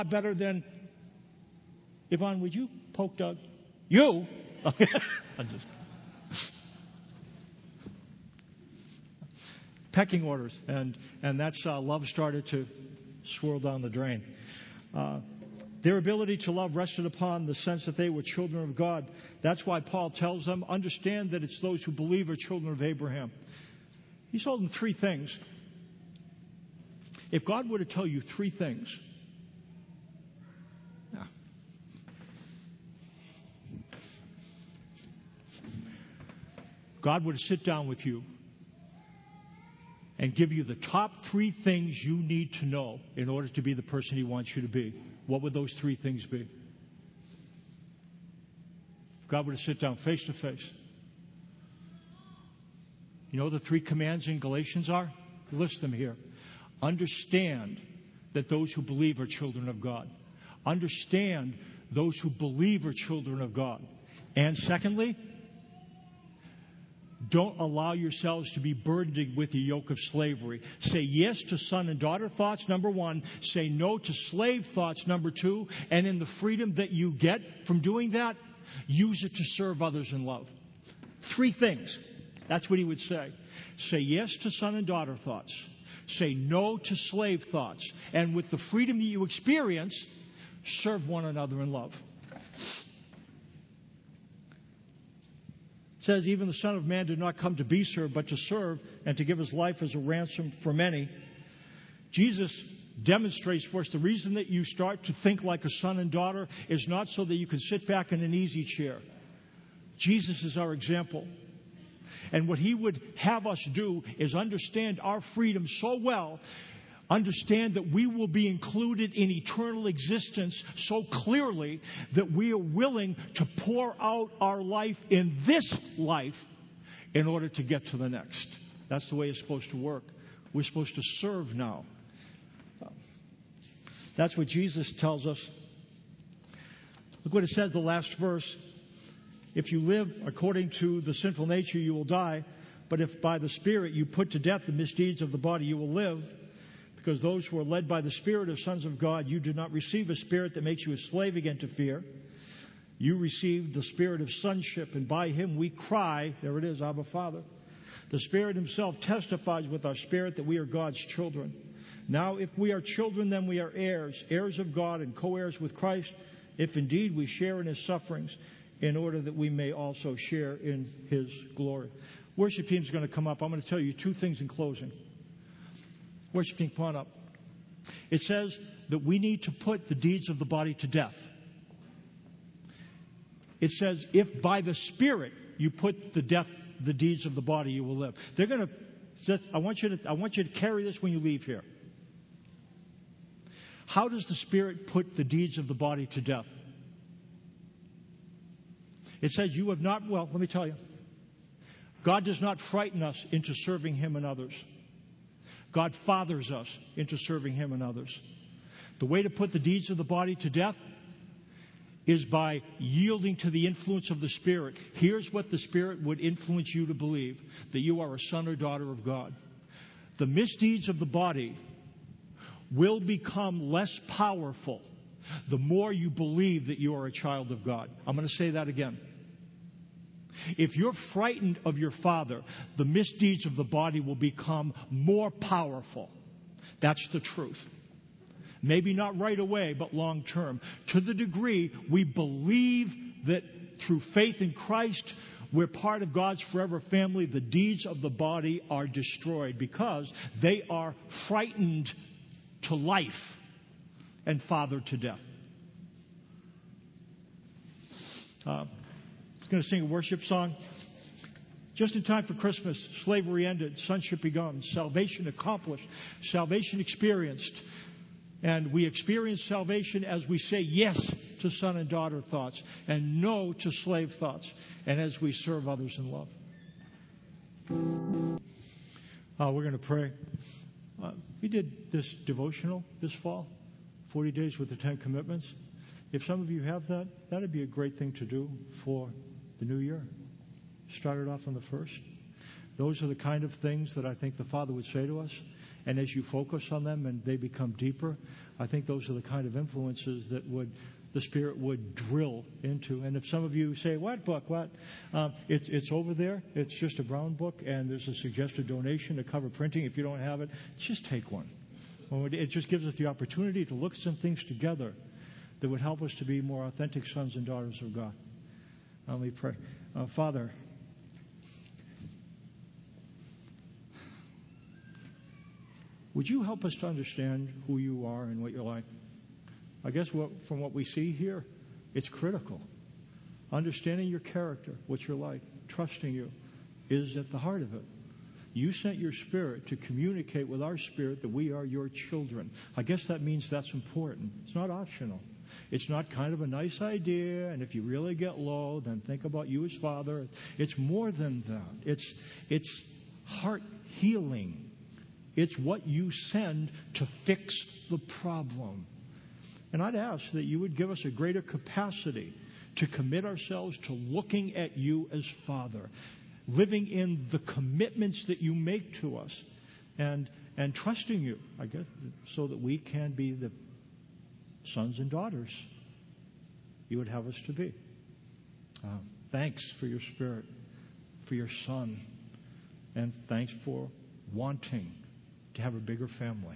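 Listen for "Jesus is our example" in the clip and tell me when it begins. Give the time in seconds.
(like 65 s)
109 s.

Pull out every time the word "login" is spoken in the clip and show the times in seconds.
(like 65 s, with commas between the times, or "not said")
not said.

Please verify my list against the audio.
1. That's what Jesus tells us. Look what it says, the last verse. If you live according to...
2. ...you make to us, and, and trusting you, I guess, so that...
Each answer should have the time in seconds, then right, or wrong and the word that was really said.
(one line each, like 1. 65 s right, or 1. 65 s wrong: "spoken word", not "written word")
1. 134 s right
2. 368 s right.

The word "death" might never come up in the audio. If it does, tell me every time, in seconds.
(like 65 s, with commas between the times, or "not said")
144 s, 180 s, 186 s, 196 s, 210 s, 254 s.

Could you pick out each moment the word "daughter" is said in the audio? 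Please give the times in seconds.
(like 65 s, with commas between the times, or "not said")
71 s, 84 s, 106 s, 218 s, 271 s, 317 s, 375 s.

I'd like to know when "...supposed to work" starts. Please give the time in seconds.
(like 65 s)
129 s.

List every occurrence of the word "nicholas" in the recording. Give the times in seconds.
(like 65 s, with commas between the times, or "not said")
not said.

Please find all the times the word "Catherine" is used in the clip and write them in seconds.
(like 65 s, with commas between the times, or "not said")
not said.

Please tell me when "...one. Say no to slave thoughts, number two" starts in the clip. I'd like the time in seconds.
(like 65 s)
72 s.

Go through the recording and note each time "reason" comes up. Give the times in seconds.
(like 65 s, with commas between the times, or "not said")
103 s.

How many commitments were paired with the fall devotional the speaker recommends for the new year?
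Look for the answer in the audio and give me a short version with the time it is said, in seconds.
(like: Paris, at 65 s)
10, at 284 s.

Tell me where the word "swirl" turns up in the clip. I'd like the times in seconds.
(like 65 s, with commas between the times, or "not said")
13 s.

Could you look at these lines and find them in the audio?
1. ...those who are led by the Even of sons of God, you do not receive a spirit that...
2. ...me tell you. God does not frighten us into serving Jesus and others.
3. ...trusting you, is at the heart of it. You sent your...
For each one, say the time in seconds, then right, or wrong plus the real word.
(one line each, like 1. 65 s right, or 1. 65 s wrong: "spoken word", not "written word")
1. 147 s wrong: "Spirit", not "Even"
2. 200 s wrong: "Him", not "Jesus"
3. 335 s right.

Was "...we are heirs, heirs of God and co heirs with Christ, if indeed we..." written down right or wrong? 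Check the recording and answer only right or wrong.
right.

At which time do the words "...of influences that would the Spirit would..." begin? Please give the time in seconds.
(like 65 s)
299 s.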